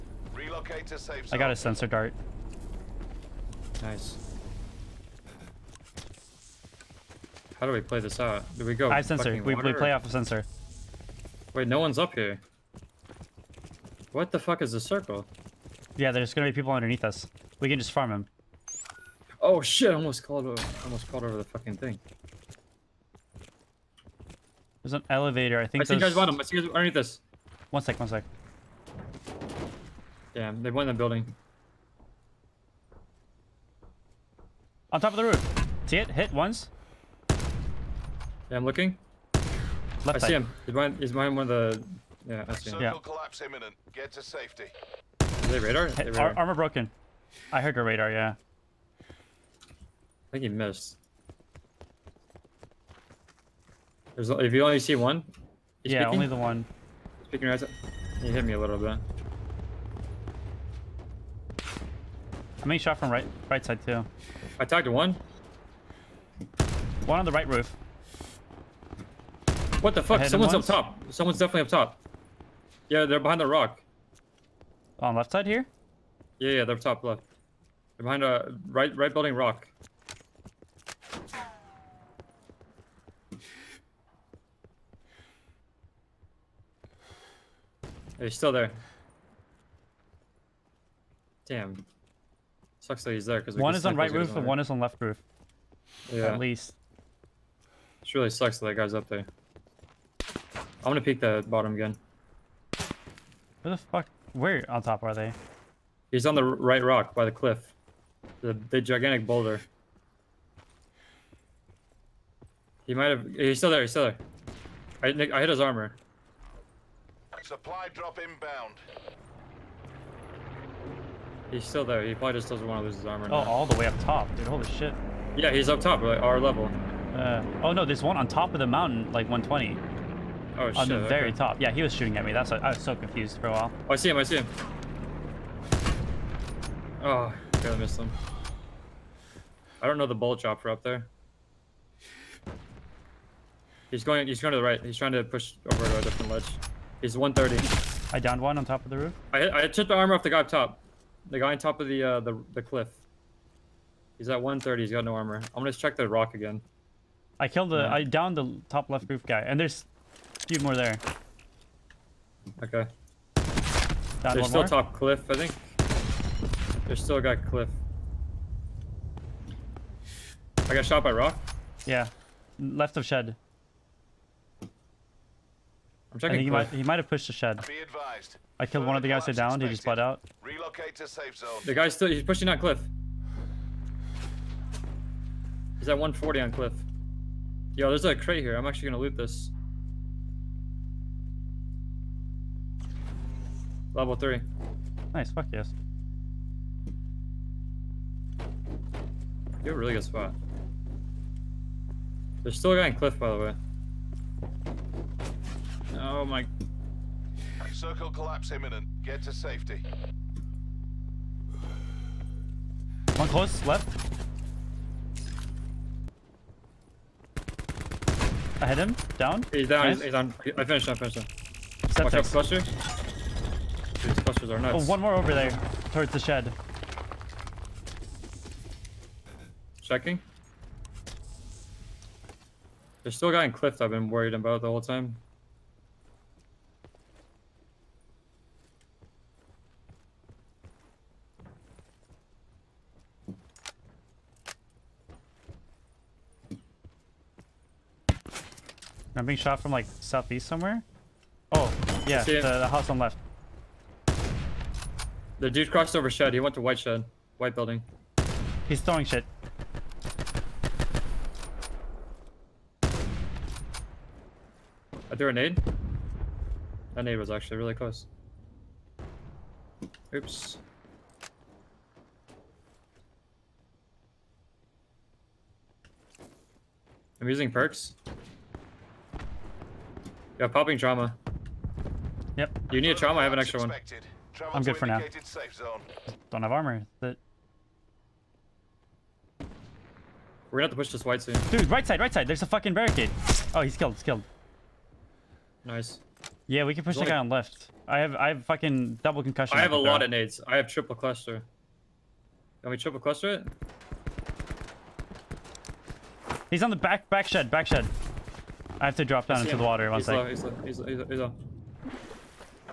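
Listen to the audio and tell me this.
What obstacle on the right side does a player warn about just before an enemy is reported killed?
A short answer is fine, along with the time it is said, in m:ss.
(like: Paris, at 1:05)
Barricade, at 4:52.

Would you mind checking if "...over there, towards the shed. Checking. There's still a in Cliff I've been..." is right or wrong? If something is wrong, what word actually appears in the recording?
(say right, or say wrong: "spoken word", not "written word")
right.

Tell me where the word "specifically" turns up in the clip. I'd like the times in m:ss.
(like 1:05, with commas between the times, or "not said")
not said.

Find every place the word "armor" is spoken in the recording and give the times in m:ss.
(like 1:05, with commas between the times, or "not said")
0:46, 1:55, 2:03, 2:29, 2:35, 4:46.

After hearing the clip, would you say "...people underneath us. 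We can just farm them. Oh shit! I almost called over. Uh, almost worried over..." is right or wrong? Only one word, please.
wrong.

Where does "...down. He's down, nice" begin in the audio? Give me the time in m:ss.
3:39.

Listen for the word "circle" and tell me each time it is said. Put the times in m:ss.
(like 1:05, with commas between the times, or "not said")
0:14, 3:27.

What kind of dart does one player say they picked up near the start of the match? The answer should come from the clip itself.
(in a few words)
Sensor dart.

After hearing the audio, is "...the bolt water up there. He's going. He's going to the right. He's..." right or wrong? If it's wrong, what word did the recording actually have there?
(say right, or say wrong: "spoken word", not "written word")
wrong: "chopper", not "water".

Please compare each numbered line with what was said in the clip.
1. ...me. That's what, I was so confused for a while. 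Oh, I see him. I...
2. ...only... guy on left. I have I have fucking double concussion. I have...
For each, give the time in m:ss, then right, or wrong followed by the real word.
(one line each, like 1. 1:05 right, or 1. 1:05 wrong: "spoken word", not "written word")
1. 2:12 right
2. 4:57 right.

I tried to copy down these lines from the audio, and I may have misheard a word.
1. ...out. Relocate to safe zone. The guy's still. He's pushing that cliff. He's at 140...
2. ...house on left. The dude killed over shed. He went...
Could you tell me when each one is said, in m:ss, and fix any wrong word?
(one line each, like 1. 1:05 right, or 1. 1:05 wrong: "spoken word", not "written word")
1. 3:00 right
2. 4:12 wrong: "crossed", not "killed".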